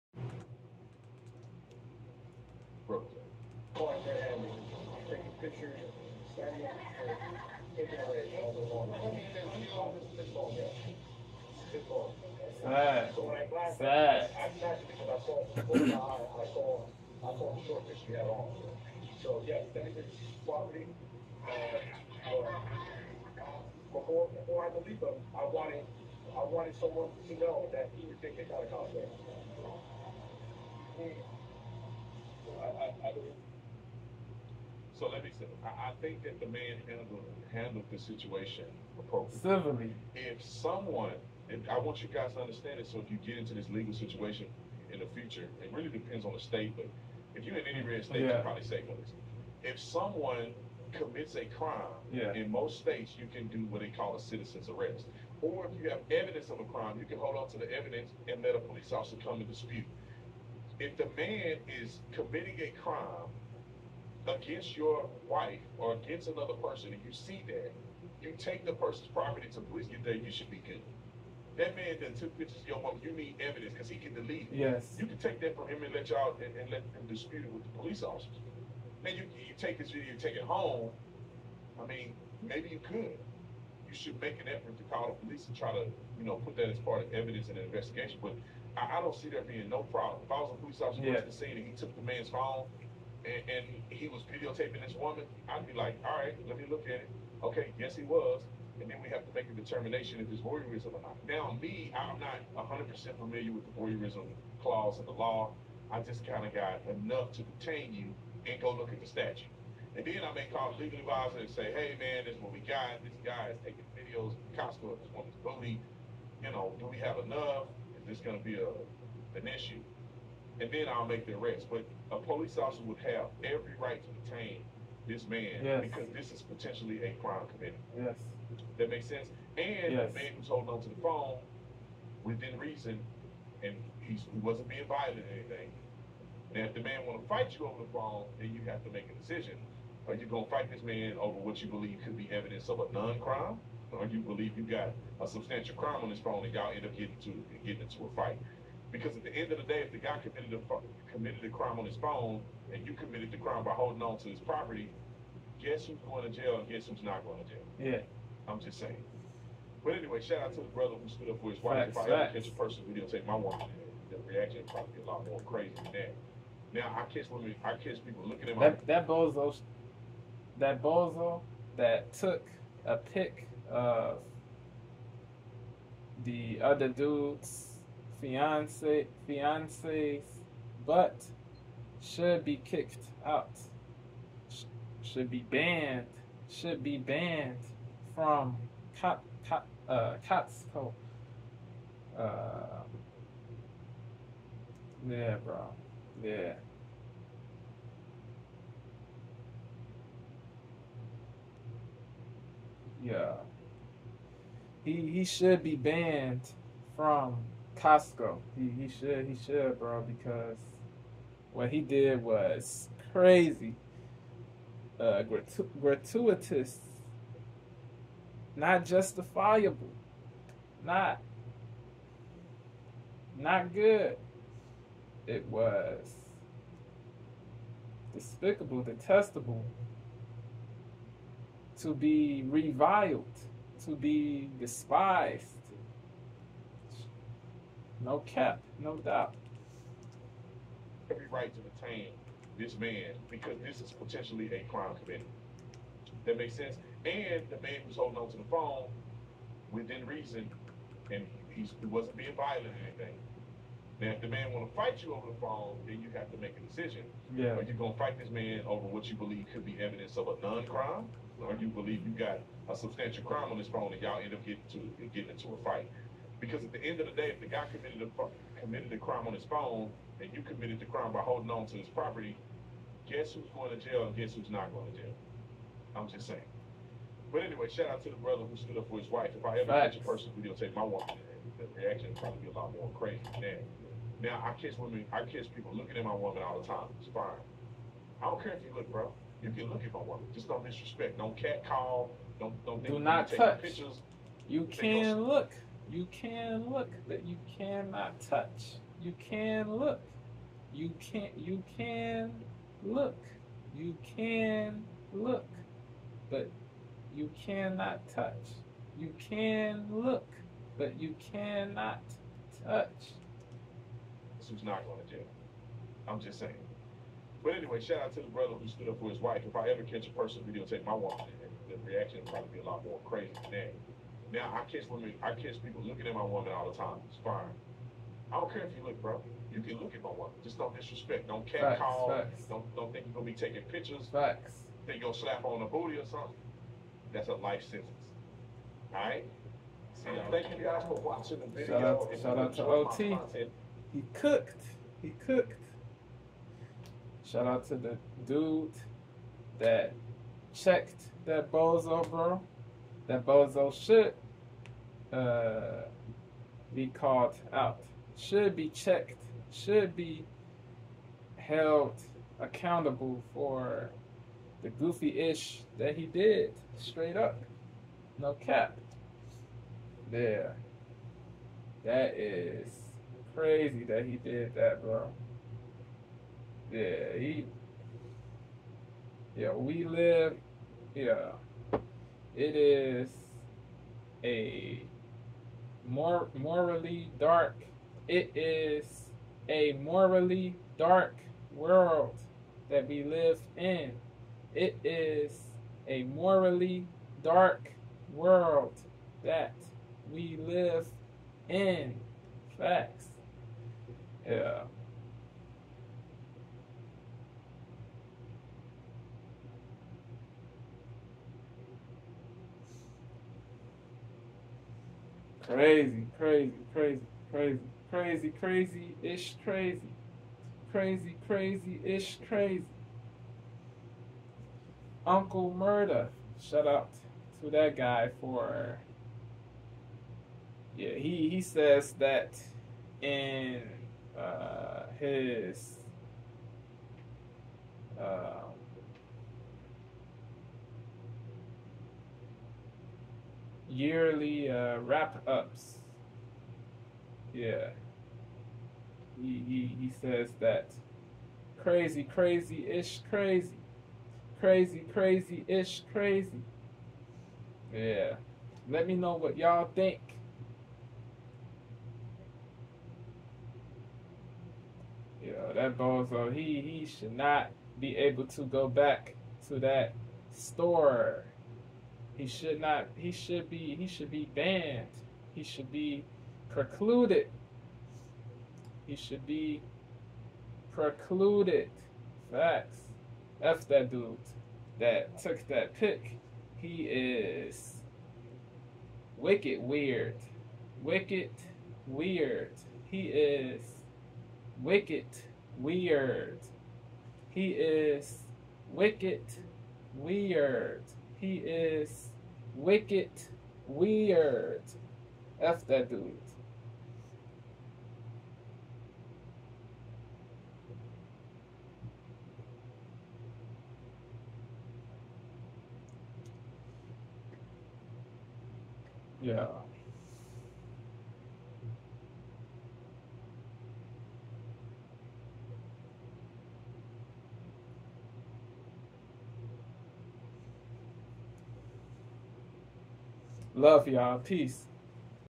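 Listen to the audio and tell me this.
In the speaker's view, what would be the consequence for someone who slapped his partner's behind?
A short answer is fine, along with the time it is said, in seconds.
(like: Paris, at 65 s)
life sentence, at 337 s.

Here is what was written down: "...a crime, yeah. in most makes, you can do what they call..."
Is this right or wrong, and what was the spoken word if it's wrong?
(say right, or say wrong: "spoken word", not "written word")
wrong: "states", not "makes".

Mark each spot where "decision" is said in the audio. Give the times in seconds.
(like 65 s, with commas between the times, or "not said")
139 s, 256 s.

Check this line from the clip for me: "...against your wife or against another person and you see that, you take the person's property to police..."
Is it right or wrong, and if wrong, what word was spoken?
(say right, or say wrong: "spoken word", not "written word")
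right.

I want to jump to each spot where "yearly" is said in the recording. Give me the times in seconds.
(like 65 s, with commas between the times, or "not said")
443 s.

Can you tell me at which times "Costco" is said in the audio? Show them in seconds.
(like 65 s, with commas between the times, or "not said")
114 s, 190 s, 207 s.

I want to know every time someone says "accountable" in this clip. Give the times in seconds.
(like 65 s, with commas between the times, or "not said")
362 s.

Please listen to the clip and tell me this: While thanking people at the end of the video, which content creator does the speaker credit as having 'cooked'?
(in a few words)
OT.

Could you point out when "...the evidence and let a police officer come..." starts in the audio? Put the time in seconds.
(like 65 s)
57 s.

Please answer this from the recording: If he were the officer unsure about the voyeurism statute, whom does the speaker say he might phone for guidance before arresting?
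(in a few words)
legal advisor.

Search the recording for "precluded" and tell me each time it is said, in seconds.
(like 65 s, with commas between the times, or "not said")
476 s, 480 s.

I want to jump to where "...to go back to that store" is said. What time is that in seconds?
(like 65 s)
468 s.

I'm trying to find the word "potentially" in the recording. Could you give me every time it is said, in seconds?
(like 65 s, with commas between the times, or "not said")
126 s, 243 s.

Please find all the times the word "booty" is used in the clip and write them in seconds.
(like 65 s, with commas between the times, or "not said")
115 s, 335 s.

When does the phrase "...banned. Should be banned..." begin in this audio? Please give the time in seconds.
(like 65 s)
185 s.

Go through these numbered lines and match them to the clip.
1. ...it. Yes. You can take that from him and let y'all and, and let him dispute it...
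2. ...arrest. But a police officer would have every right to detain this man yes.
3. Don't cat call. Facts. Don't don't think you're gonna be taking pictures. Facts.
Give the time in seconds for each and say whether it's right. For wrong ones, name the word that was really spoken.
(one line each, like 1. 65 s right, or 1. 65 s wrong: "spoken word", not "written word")
1. 74 s right
2. 121 s right
3. 331 s right.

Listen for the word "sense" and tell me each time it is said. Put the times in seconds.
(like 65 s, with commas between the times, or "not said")
129 s, 246 s.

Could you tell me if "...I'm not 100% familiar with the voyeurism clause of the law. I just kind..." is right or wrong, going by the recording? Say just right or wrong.
right.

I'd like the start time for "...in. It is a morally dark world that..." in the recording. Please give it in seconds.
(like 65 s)
393 s.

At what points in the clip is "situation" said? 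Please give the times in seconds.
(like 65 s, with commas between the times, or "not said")
37 s, 43 s.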